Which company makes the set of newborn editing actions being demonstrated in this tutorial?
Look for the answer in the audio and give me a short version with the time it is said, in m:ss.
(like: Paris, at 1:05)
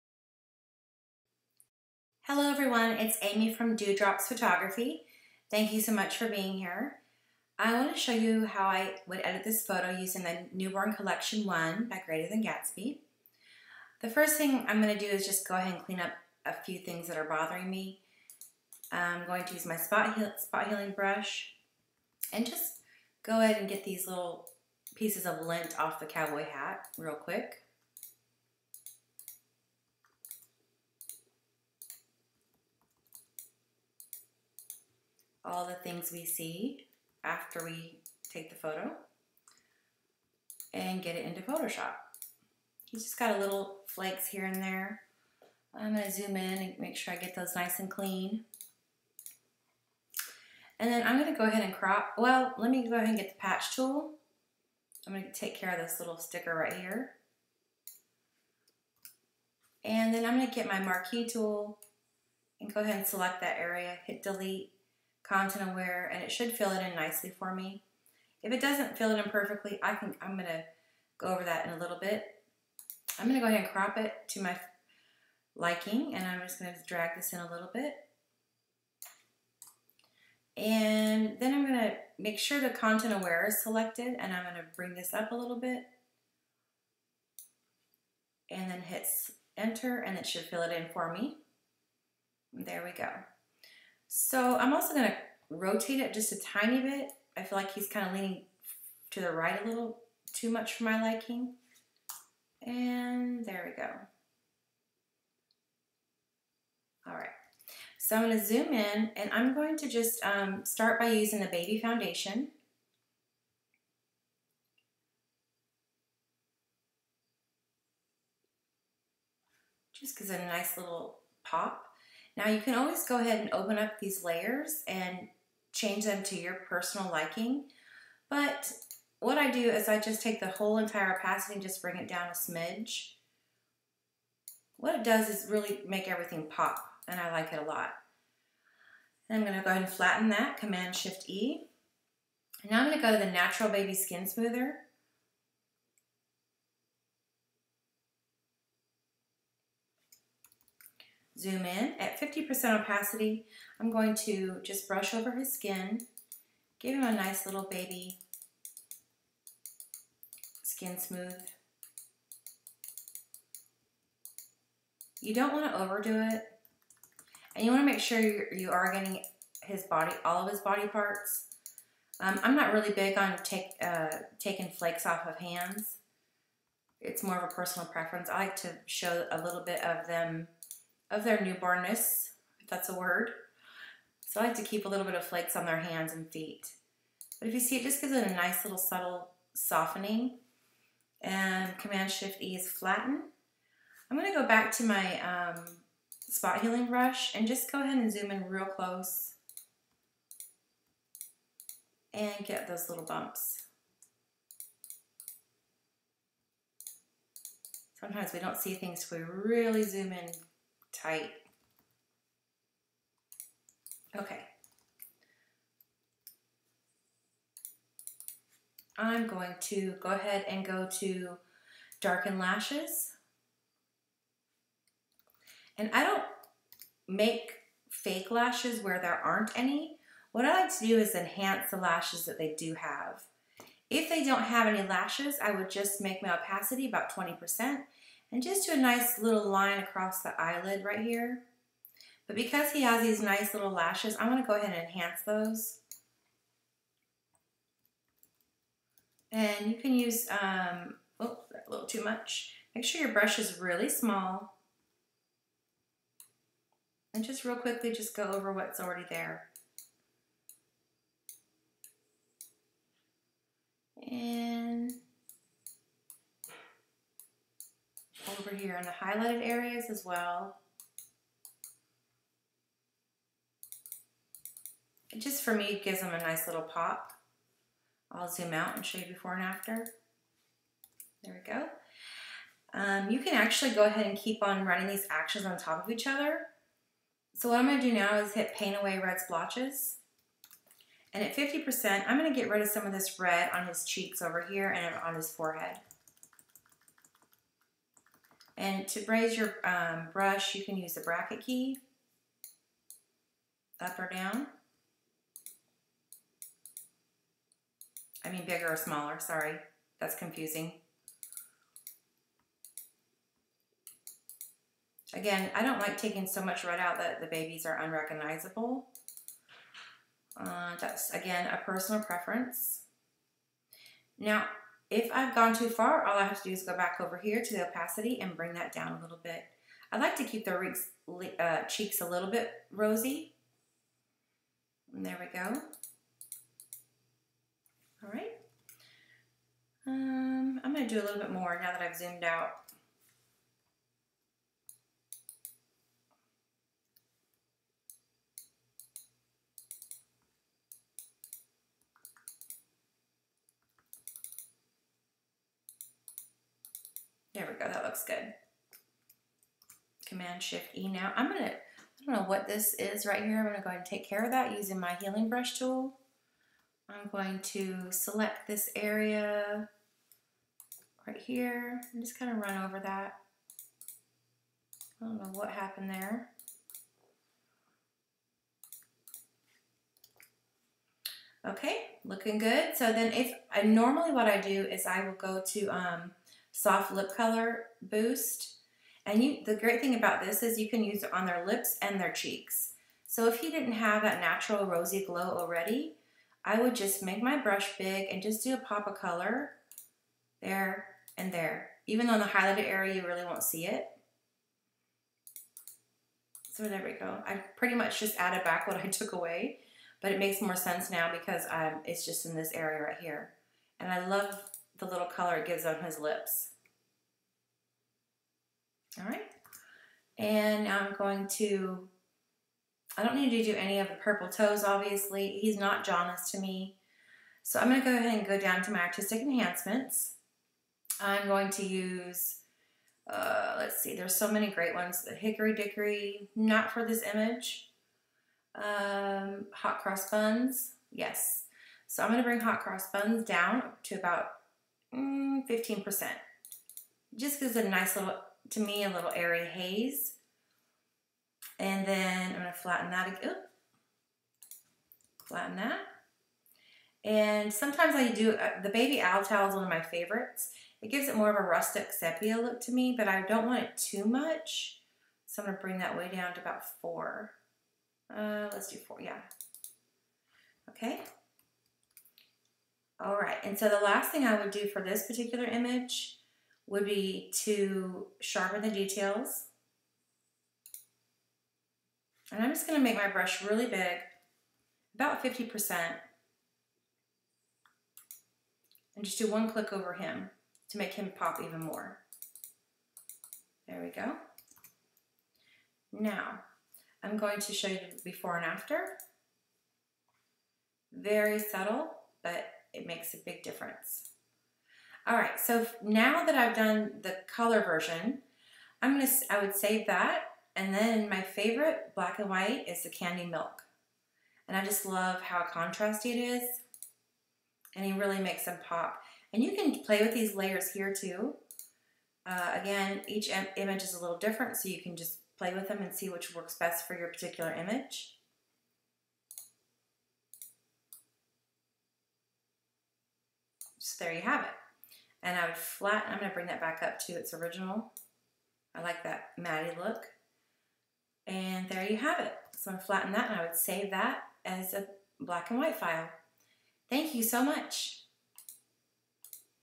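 Greater Than Gatsby, at 0:12.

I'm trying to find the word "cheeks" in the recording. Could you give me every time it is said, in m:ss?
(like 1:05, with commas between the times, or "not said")
4:53, 5:31, 6:32.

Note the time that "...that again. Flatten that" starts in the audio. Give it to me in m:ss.
7:32.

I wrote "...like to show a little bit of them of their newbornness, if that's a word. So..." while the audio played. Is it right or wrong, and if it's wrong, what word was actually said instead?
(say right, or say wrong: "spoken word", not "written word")
right.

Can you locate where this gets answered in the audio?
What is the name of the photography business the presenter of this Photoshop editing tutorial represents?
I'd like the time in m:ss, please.
0:03.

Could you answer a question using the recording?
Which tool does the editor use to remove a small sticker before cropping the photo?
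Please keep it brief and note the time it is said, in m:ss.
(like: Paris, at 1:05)
patch tool, at 0:53.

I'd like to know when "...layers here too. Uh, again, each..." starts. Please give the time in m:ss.
8:40.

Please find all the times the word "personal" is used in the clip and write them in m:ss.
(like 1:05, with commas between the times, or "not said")
2:06, 2:57, 5:21.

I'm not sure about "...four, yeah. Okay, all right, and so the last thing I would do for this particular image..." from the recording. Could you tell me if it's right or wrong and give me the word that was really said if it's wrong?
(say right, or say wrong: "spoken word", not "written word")
right.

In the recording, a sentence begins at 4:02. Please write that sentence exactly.
But because he has these nice little lashes, I'm gonna go ahead and enhance those.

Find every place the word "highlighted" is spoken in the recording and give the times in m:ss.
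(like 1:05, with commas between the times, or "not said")
4:28, 6:42.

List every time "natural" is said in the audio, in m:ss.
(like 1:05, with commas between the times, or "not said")
2:23, 6:34.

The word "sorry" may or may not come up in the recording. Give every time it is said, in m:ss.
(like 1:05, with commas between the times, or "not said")
5:09.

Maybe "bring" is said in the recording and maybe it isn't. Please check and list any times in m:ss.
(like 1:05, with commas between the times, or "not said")
1:24, 2:11, 5:28, 7:22, 7:45, 8:56.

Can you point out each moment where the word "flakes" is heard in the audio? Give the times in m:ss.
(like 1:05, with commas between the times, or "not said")
0:43, 2:54, 3:05.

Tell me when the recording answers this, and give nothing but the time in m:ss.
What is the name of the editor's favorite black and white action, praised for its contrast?
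8:32.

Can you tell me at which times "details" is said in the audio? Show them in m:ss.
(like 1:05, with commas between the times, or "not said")
7:58.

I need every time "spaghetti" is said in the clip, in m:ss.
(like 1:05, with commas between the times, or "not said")
not said.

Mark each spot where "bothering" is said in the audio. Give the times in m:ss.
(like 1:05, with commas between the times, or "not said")
0:17.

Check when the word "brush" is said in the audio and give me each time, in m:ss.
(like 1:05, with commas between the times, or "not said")
0:20, 2:34, 3:16, 4:13, 5:00, 6:05, 6:37, 8:03.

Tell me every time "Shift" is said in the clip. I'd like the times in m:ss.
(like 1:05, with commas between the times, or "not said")
2:20, 3:11, 6:00.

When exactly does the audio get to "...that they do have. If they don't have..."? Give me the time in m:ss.
3:52.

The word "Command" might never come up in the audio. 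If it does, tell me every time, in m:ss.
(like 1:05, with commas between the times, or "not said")
2:20, 3:11, 6:00.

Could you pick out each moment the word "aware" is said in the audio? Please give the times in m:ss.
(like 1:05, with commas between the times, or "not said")
1:05, 1:23.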